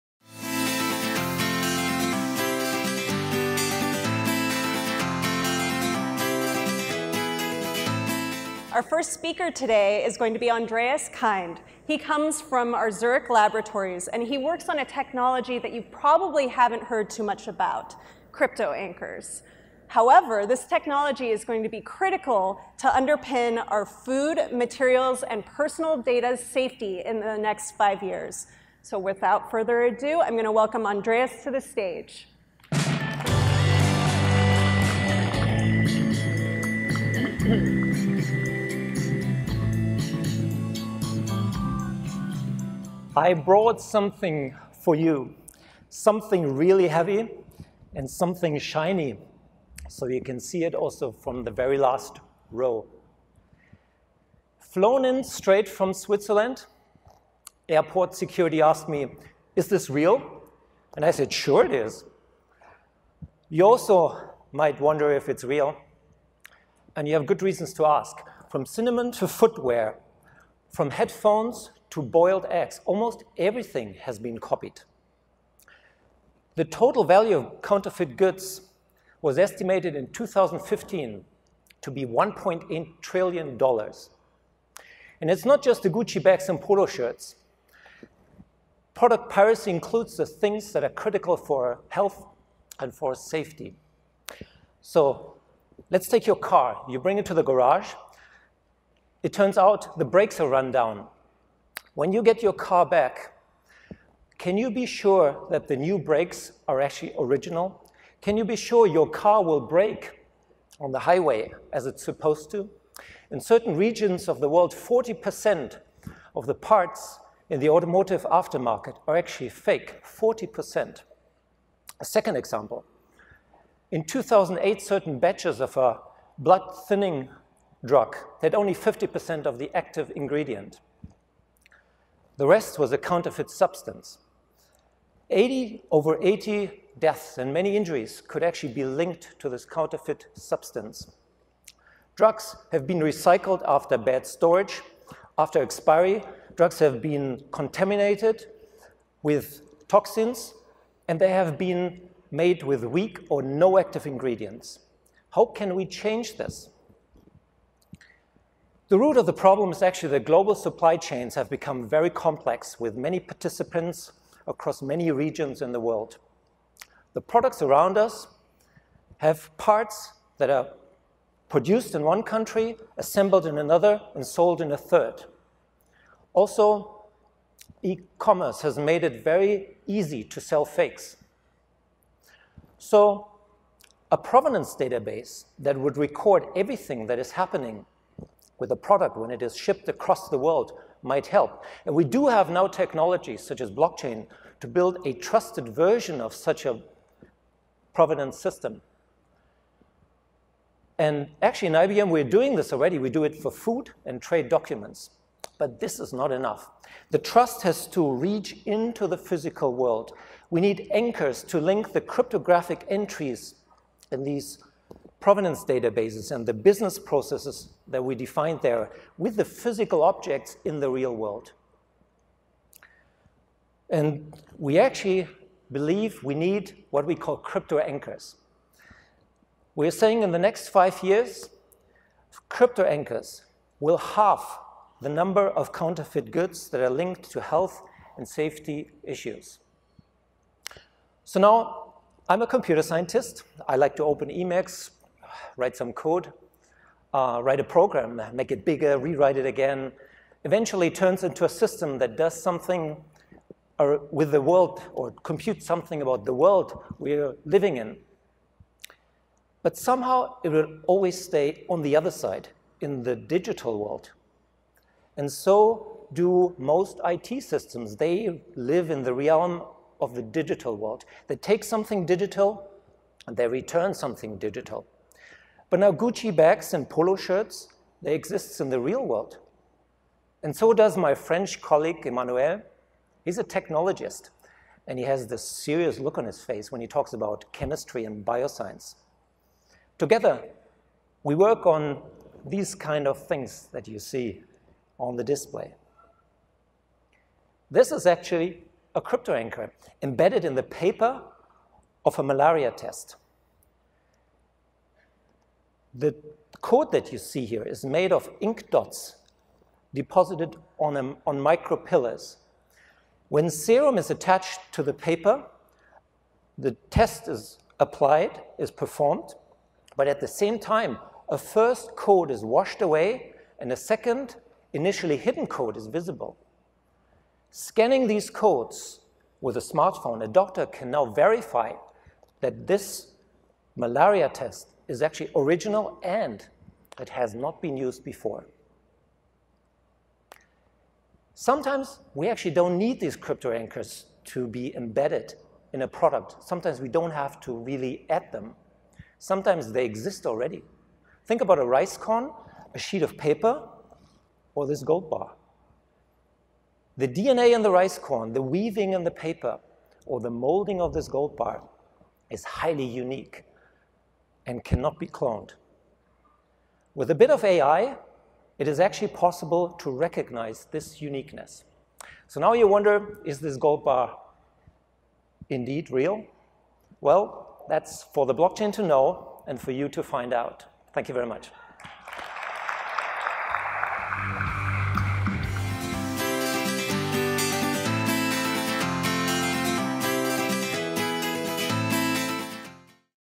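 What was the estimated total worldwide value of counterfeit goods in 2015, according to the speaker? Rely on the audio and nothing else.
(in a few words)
$1.8 trillion.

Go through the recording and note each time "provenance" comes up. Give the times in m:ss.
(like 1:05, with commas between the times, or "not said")
3:04, 3:17, 3:35.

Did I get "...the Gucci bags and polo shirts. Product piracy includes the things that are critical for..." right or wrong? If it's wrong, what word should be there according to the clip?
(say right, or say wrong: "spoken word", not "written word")
right.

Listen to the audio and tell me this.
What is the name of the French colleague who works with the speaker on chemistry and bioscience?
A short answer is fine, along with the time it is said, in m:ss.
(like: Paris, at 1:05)
Emmanuel, at 4:42.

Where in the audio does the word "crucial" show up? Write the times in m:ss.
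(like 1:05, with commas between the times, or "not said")
not said.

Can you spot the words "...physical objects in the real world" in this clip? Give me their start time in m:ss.
3:39.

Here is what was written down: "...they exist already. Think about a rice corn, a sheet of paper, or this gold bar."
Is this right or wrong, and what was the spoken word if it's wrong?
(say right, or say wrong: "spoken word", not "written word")
right.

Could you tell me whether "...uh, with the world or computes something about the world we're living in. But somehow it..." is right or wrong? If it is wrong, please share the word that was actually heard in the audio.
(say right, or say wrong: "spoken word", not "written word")
right.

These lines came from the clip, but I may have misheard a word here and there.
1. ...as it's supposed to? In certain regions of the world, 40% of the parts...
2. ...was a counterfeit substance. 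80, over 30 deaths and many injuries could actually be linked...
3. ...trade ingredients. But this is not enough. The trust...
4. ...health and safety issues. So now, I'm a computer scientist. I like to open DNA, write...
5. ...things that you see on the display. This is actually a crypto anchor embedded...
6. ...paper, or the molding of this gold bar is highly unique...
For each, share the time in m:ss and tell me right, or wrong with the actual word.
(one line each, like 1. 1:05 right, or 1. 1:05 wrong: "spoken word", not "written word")
1. 1:51 right
2. 2:12 wrong: "80", not "30"
3. 3:24 wrong: "documents", not "ingredients"
4. 3:57 wrong: "Emacs", not "DNA"
5. 4:53 right
6. 5:59 right.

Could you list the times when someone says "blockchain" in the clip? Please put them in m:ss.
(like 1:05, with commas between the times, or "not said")
3:13, 6:18.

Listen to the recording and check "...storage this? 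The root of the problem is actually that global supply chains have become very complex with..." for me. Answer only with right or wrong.
wrong.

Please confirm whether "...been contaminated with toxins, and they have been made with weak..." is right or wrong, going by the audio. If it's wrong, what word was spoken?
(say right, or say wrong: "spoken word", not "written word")
right.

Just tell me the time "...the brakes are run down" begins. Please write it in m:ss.
1:39.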